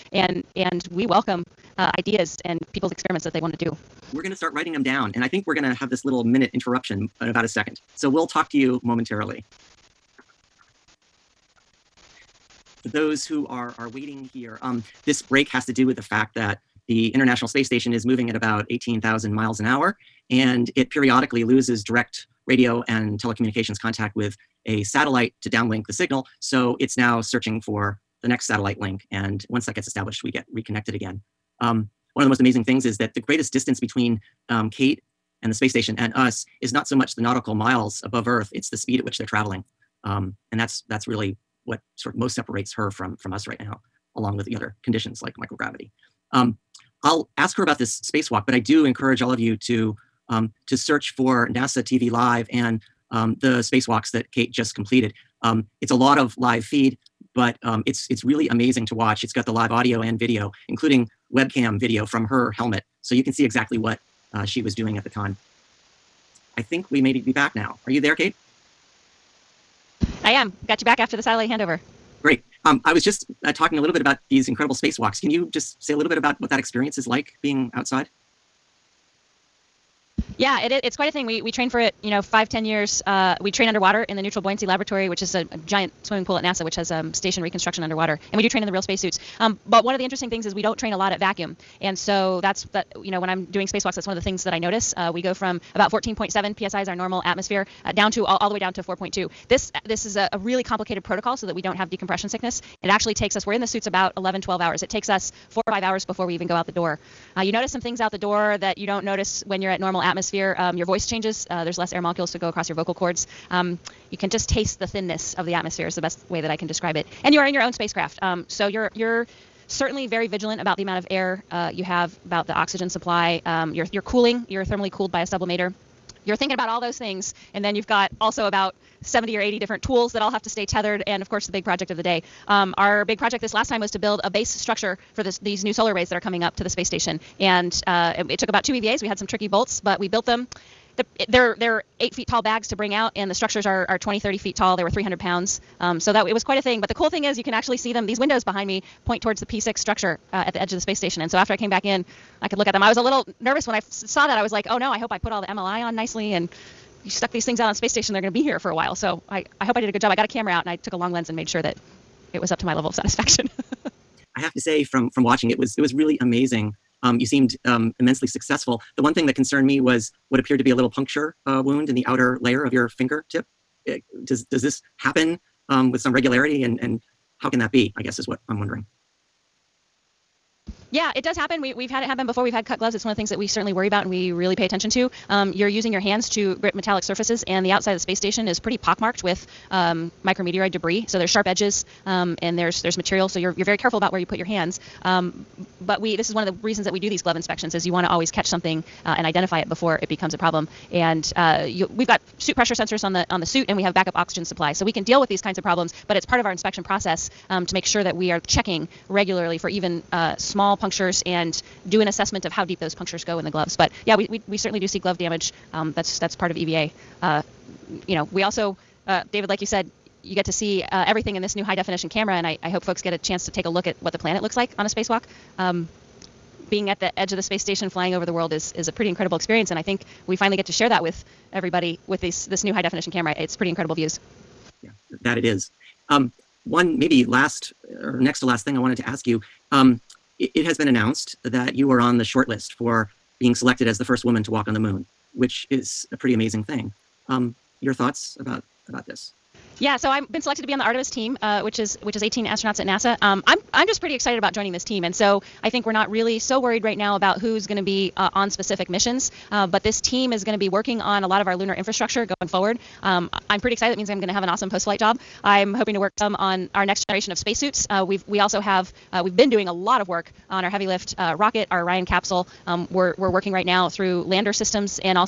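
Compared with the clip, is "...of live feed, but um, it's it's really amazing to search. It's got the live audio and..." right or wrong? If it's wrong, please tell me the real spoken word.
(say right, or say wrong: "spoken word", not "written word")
wrong: "watch", not "search".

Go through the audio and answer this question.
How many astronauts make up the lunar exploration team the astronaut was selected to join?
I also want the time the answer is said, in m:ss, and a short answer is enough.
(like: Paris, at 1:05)
18, at 4:12.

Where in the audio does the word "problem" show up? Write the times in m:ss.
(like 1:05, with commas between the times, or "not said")
3:20, 3:25.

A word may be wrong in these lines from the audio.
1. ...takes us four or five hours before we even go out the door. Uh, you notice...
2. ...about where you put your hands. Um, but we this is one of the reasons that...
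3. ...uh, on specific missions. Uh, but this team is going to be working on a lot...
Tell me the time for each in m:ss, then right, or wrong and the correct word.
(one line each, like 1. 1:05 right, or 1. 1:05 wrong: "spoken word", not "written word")
1. 1:44 right
2. 3:13 right
3. 4:18 right.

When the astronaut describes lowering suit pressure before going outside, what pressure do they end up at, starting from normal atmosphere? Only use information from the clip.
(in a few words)
4.2 psi.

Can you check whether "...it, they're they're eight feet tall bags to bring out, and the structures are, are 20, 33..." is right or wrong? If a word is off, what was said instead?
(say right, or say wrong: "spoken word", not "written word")
wrong: "30", not "33".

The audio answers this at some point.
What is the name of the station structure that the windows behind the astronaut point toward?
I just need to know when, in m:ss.
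2:29.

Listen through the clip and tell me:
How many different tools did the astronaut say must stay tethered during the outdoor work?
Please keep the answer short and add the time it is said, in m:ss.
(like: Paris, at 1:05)
70 or 80, at 2:09.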